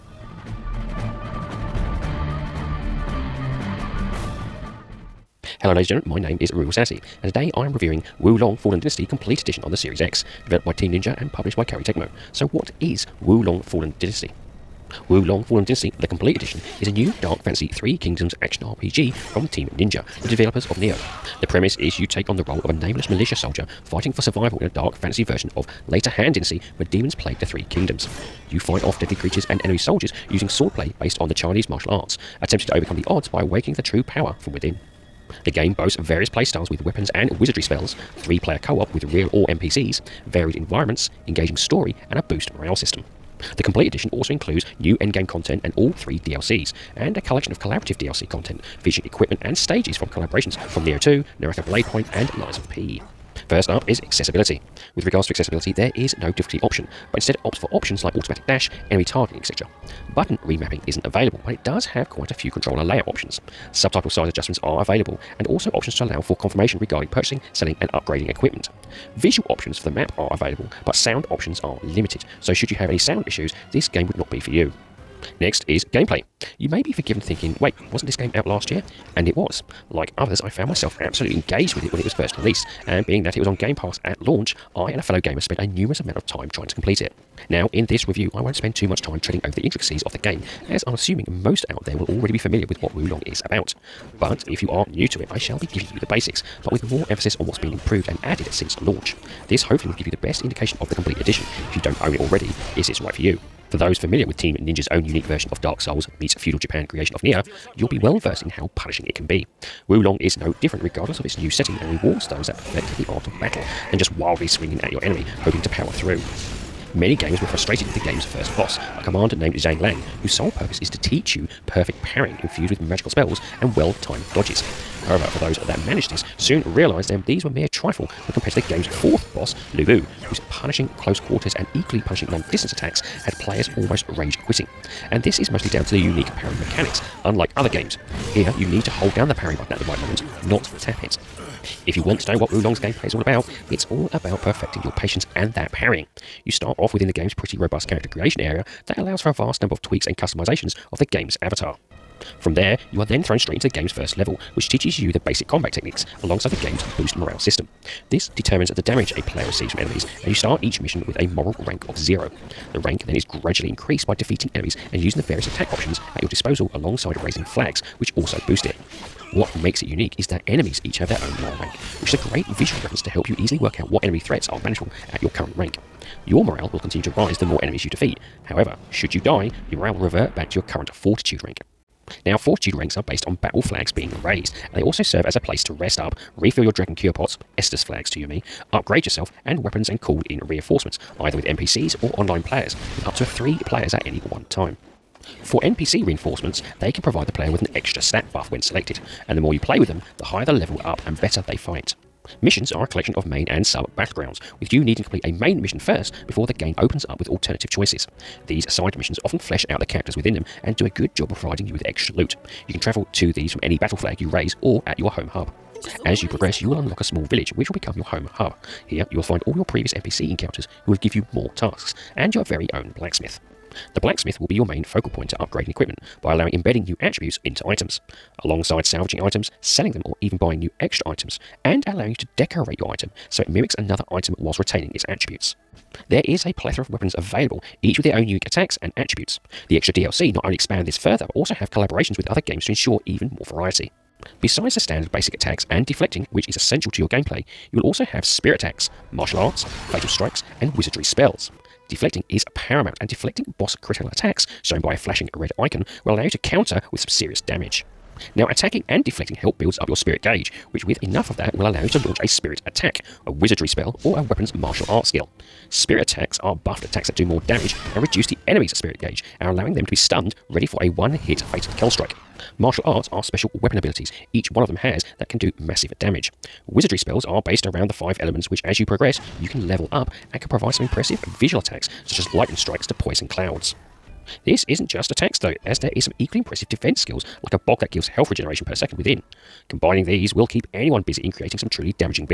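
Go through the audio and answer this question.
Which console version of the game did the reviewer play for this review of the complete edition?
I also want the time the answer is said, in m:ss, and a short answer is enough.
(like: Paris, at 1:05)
Series X, at 0:09.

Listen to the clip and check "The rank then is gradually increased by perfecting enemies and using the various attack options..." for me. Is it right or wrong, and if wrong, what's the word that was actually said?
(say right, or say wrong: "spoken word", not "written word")
wrong: "defeating", not "perfecting".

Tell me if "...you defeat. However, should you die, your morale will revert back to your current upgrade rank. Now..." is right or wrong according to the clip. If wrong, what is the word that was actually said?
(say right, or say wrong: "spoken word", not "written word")
wrong: "fortitude", not "upgrade".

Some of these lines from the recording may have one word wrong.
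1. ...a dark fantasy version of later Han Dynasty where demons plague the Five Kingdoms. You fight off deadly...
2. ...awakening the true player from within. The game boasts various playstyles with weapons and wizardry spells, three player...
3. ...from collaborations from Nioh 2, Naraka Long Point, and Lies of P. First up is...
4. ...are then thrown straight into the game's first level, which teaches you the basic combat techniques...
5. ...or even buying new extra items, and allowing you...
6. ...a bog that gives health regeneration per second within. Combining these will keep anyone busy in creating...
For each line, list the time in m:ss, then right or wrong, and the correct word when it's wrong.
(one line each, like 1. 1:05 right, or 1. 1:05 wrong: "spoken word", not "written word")
1. 0:24 wrong: "Three", not "Five"
2. 0:33 wrong: "power", not "player"
3. 0:49 wrong: "Blade", not "Long"
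4. 2:33 right
5. 3:50 right
6. 4:47 right.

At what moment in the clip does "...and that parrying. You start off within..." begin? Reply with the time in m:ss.
2:25.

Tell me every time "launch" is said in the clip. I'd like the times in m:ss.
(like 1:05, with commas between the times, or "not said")
1:24, 1:38, 4:22.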